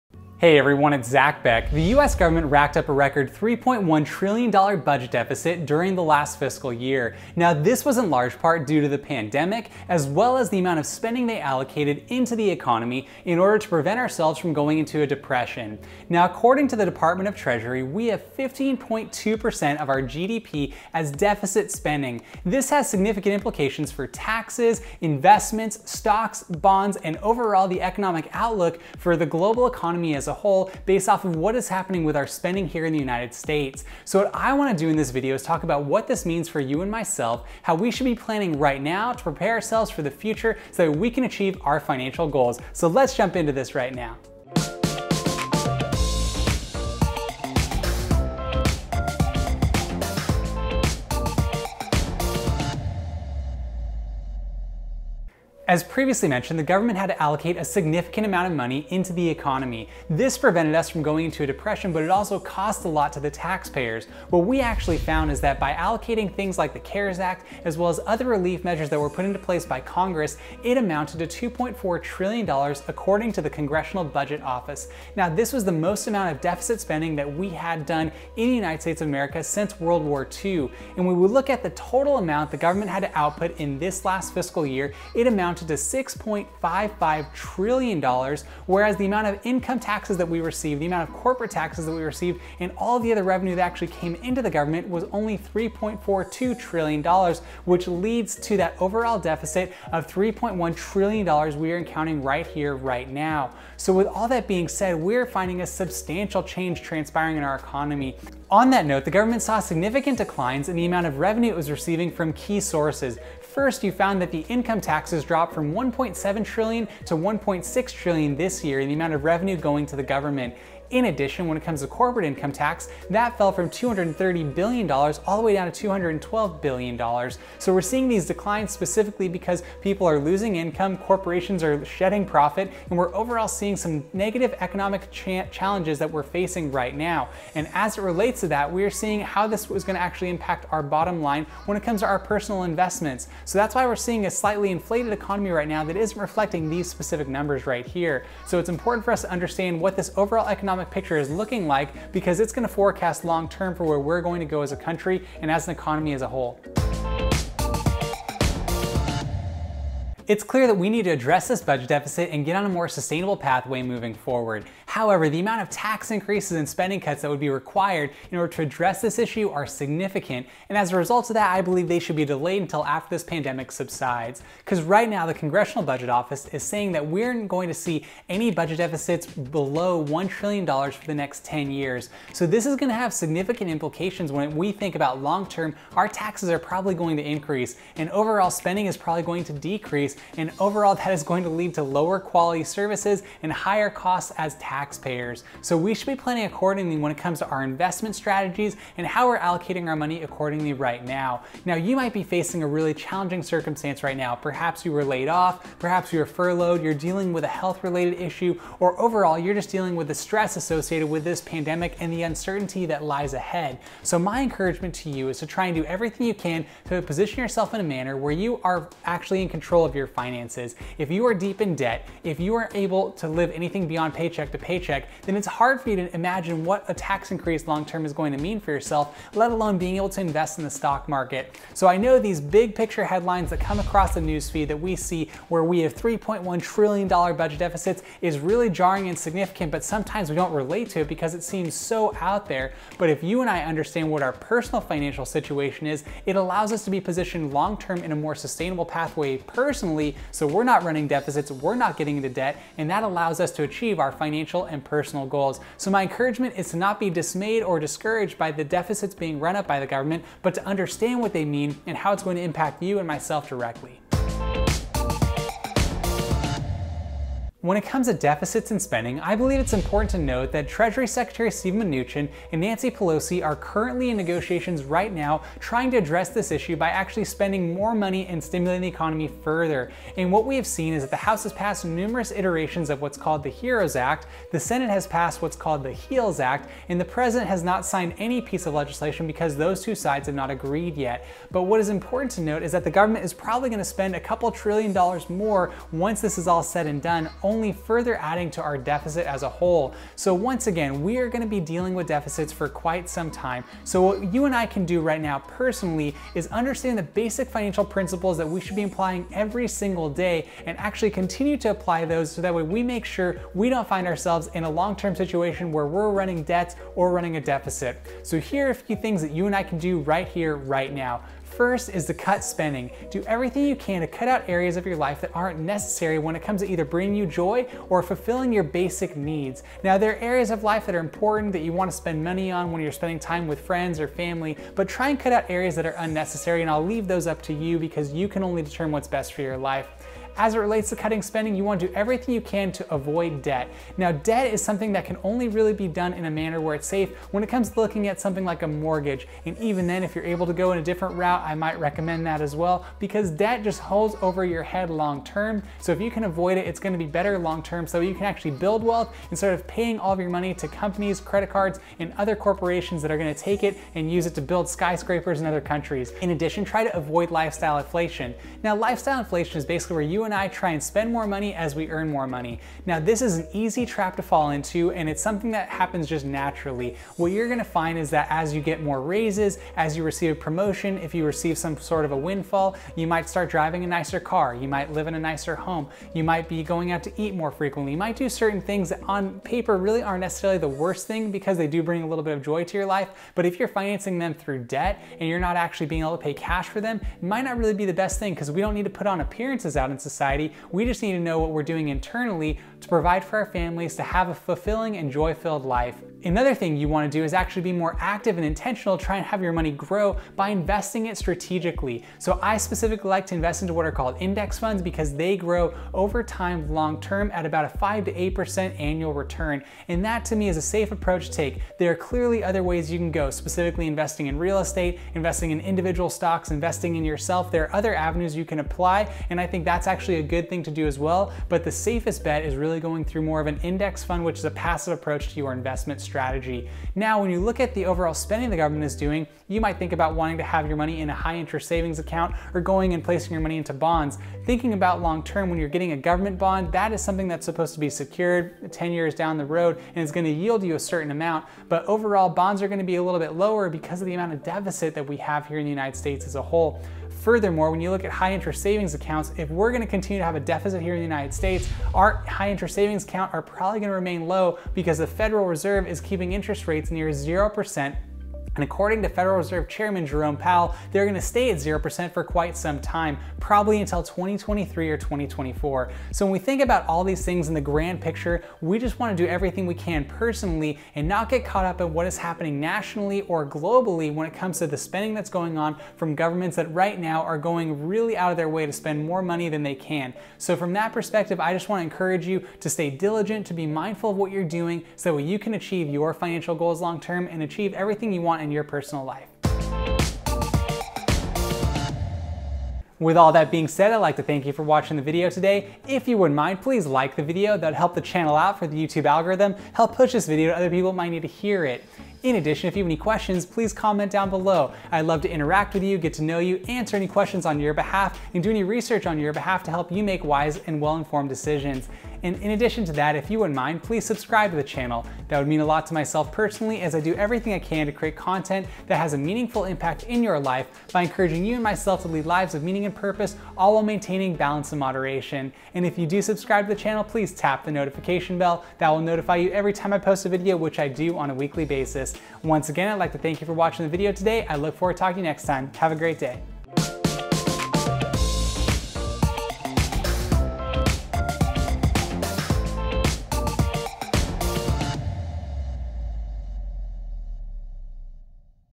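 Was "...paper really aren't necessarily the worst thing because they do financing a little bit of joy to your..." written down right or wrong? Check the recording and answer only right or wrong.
wrong.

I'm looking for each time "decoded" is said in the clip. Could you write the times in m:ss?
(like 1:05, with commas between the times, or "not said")
not said.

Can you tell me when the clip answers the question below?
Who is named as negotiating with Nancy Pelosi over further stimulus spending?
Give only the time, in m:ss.
4:31.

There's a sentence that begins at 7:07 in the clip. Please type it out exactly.
There are other avenues you can apply.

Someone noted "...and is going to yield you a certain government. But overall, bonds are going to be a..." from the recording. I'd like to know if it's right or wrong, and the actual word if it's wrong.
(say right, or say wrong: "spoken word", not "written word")
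wrong: "amount", not "government".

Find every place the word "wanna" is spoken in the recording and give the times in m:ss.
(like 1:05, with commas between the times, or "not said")
0:34, 6:46.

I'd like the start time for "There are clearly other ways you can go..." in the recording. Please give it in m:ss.
7:01.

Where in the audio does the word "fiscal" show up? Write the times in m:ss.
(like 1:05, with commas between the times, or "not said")
0:06, 1:24.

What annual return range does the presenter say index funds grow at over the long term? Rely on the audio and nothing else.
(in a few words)
5 to 8%.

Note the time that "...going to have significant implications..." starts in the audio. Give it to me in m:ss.
3:02.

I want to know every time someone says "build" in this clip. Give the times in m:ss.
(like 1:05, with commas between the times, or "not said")
5:58, 6:04.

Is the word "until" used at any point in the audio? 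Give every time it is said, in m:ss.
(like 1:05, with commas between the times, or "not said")
2:52, 7:53.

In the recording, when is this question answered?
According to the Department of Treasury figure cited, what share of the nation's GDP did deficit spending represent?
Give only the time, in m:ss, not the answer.
0:18.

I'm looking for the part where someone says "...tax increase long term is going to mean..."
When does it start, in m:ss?
3:46.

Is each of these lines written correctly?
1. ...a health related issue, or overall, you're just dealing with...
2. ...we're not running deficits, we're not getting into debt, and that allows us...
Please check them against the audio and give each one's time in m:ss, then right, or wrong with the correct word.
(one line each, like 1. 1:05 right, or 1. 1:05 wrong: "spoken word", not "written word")
1. 3:27 right
2. 4:10 right.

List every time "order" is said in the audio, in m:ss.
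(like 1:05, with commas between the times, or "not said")
0:13, 2:48.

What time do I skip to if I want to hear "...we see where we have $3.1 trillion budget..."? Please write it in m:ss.
3:54.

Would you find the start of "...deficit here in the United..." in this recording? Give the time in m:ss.
7:40.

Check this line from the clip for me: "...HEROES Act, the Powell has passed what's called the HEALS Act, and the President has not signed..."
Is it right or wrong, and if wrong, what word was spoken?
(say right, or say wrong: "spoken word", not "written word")
wrong: "Senate", not "Powell".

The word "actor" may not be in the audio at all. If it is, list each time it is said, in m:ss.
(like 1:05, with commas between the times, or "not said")
not said.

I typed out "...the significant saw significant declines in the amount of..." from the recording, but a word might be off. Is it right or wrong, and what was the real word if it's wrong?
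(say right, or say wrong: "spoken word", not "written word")
wrong: "government", not "significant".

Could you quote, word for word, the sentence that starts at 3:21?
Now, you might be facing a really challenging circumstance right now.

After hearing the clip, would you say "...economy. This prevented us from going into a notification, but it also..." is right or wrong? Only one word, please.
wrong.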